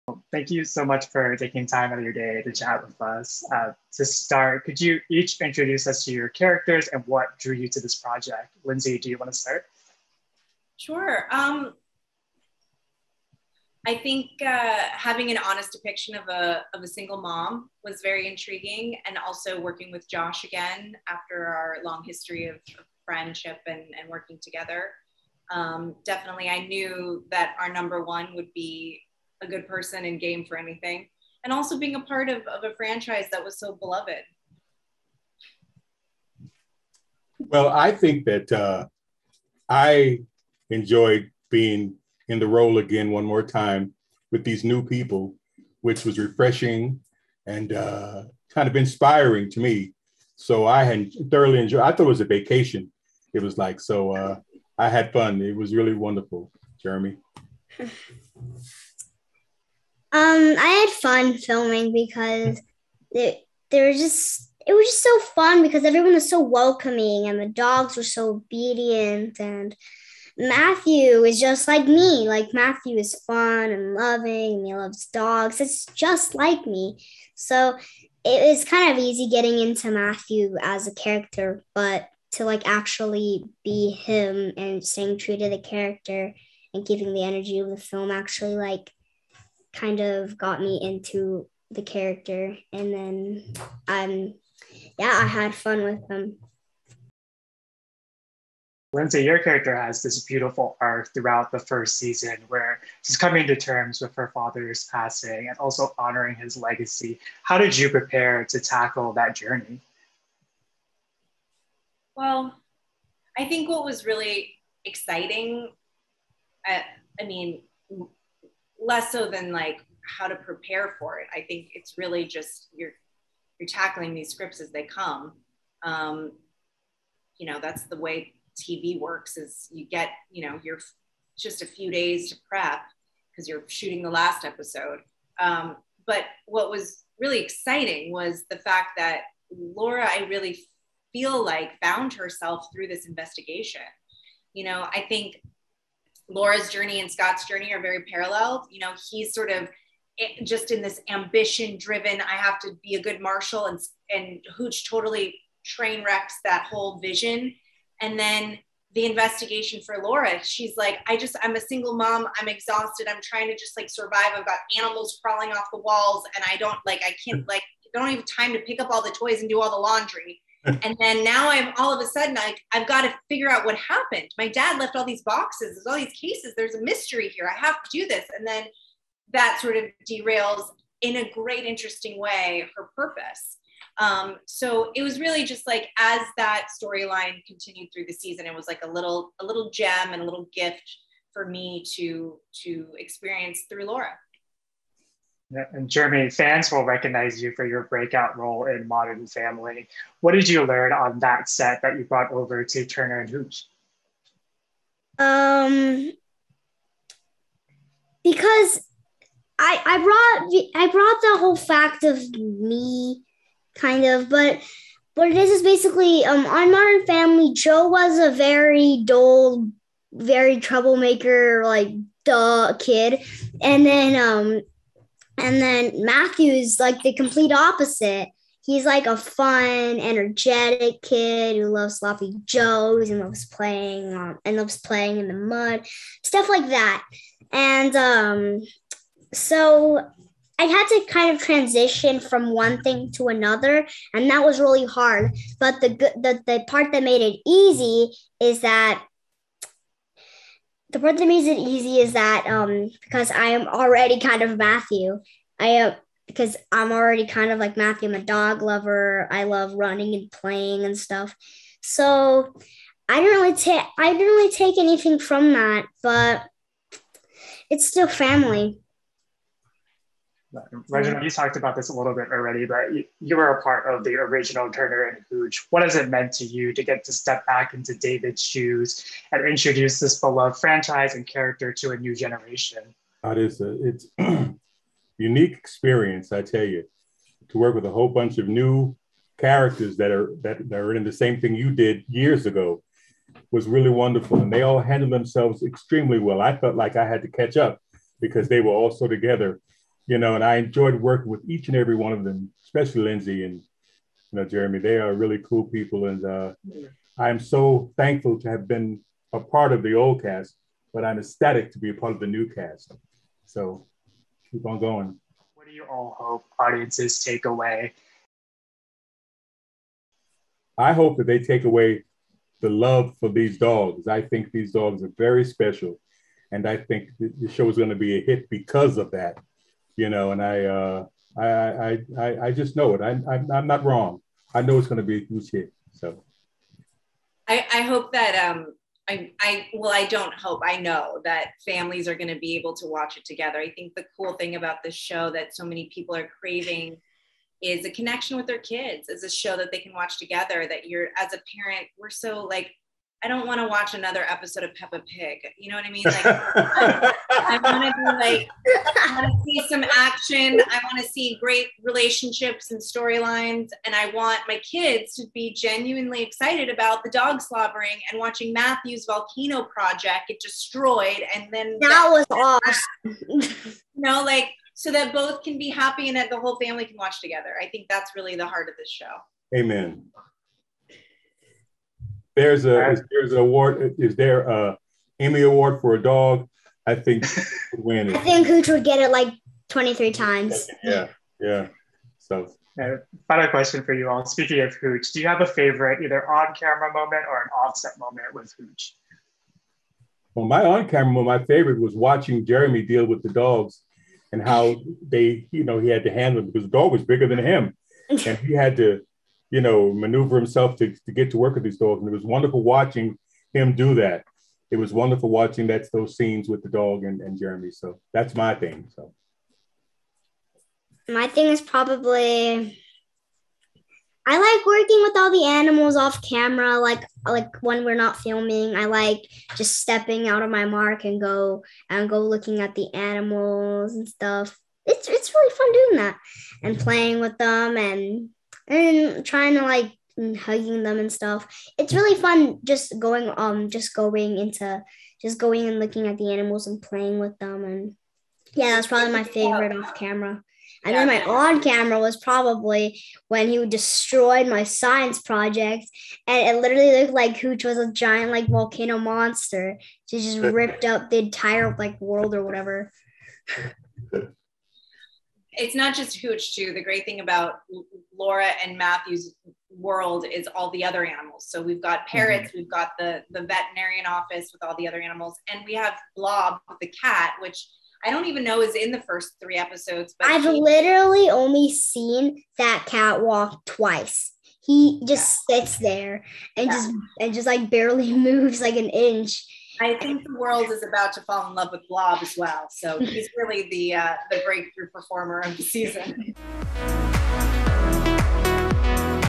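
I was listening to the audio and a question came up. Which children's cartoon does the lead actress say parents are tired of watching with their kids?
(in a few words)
Peppa Pig.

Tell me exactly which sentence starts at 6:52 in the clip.
And it was wonderful watching him do that.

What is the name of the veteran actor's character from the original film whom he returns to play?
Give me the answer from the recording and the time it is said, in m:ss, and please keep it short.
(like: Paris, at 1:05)
David, at 4:37.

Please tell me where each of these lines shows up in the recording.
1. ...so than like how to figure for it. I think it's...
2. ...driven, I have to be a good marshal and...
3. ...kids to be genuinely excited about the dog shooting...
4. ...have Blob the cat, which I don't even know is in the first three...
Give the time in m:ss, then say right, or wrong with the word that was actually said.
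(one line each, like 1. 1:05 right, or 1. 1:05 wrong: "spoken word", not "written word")
1. 1:59 wrong: "prepare", not "figure"
2. 2:31 right
3. 6:04 wrong: "slobbering", not "shooting"
4. 7:55 right.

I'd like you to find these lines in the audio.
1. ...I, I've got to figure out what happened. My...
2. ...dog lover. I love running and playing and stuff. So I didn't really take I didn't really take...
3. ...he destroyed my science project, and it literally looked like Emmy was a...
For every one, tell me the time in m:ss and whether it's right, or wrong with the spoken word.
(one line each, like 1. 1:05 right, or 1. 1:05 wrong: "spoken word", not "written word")
1. 2:52 right
2. 4:18 right
3. 7:33 wrong: "Hooch", not "Emmy".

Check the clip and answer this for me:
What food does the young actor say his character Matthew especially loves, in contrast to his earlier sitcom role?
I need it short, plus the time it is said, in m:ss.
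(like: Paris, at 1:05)
Sloppy joes, at 3:51.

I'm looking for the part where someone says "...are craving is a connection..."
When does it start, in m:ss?
5:46.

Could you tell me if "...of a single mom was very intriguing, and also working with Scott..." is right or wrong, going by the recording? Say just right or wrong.
wrong.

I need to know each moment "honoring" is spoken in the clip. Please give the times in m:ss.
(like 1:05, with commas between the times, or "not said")
1:45.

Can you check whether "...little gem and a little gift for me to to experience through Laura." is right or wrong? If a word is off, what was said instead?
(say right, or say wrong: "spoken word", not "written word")
right.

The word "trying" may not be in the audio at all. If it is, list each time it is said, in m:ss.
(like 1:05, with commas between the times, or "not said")
2:43, 7:19.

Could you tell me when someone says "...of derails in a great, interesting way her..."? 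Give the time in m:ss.
2:59.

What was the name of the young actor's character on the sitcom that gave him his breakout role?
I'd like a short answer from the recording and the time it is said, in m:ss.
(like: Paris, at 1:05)
Joe, at 3:37.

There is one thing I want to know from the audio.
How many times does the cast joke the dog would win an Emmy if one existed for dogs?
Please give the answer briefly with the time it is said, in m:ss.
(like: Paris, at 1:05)
23, at 6:29.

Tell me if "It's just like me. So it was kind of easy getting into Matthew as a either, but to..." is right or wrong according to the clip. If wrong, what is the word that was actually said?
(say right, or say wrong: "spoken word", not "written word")
wrong: "character", not "either".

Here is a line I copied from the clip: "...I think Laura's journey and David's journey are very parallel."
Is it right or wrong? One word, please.
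wrong.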